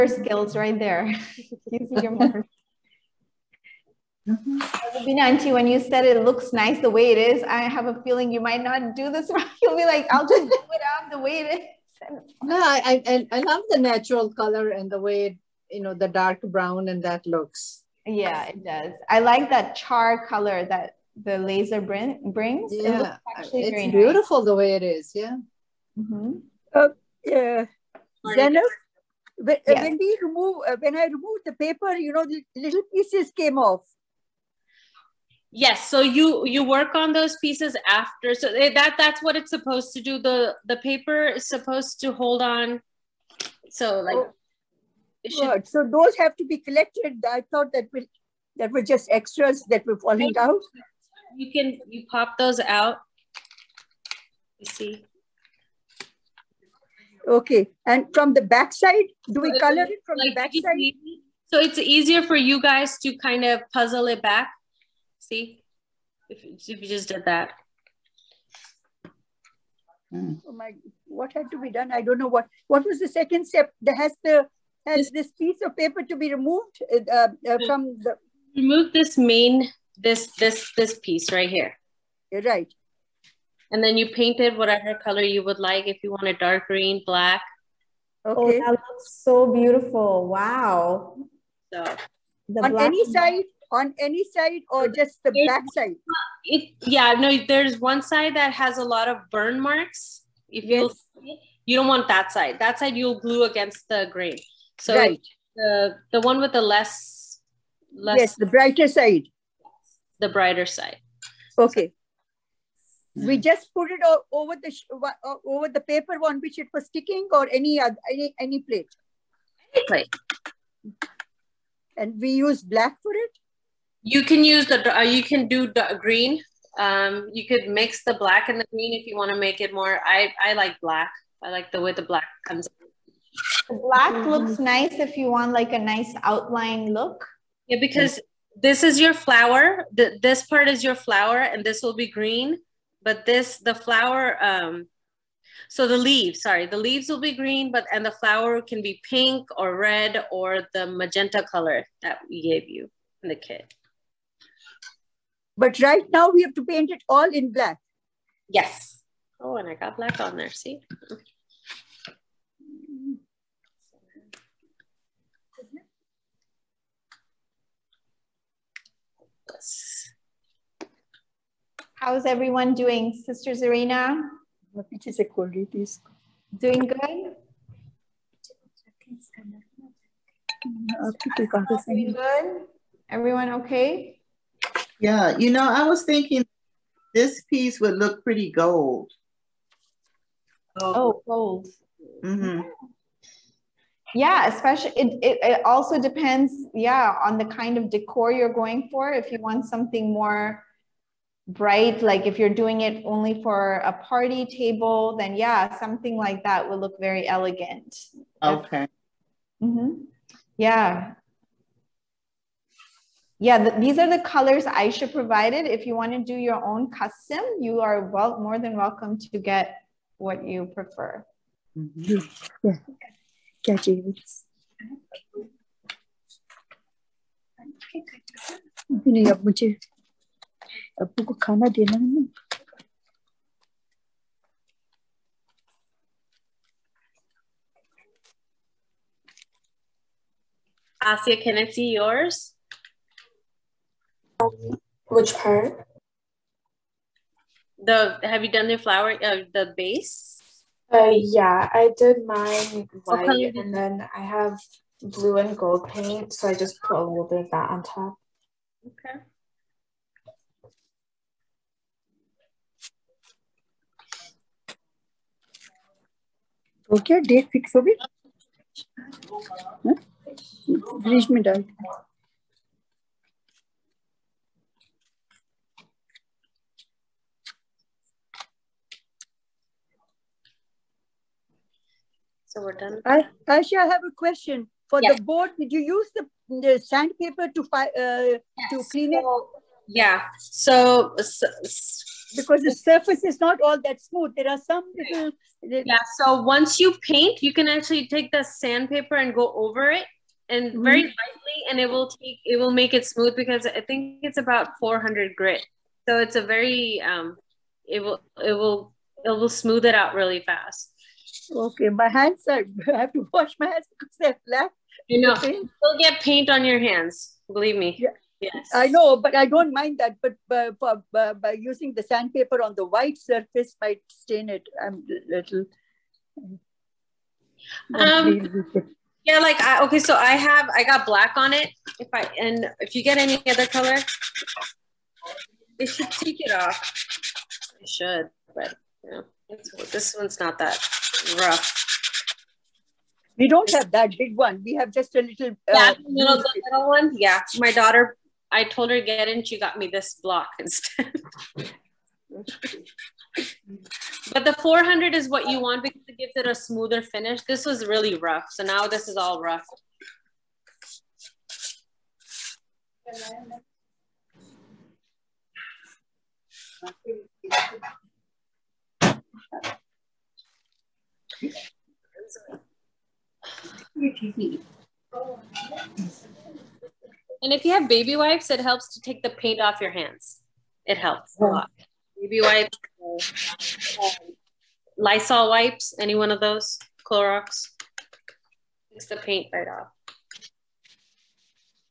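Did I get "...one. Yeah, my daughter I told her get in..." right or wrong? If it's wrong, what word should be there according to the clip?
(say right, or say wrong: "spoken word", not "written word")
right.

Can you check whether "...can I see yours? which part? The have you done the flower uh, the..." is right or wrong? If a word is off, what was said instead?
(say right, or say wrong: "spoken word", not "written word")
right.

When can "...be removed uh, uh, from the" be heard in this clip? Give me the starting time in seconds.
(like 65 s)
76 s.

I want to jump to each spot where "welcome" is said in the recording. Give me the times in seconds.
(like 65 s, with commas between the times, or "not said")
218 s.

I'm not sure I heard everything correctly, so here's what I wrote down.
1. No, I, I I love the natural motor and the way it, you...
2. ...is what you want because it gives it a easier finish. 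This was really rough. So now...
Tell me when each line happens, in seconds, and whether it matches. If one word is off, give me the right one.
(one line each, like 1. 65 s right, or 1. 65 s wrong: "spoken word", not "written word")
1. 12 s wrong: "color", not "motor"
2. 355 s wrong: "smoother", not "easier".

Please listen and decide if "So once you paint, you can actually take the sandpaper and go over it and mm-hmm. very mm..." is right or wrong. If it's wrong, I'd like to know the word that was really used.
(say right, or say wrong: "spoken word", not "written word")
right.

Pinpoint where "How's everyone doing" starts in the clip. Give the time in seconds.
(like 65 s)
171 s.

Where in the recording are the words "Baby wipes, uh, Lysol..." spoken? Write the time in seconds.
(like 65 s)
382 s.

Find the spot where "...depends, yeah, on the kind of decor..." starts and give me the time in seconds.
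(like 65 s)
195 s.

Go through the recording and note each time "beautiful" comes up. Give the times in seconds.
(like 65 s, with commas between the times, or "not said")
23 s, 89 s.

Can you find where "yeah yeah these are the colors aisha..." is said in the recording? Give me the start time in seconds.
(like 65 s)
210 s.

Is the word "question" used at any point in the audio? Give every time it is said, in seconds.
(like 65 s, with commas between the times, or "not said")
284 s.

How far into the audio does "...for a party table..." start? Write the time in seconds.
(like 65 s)
203 s.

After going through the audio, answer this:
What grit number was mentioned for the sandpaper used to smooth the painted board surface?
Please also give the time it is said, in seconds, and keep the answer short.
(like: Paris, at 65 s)
400, at 304 s.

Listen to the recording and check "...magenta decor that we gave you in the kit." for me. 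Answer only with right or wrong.
wrong.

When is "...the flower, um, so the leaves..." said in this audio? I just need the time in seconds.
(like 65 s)
143 s.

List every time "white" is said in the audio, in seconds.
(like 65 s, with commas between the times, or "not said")
253 s, 322 s.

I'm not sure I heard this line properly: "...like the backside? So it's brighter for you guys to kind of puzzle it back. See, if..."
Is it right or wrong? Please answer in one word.
wrong.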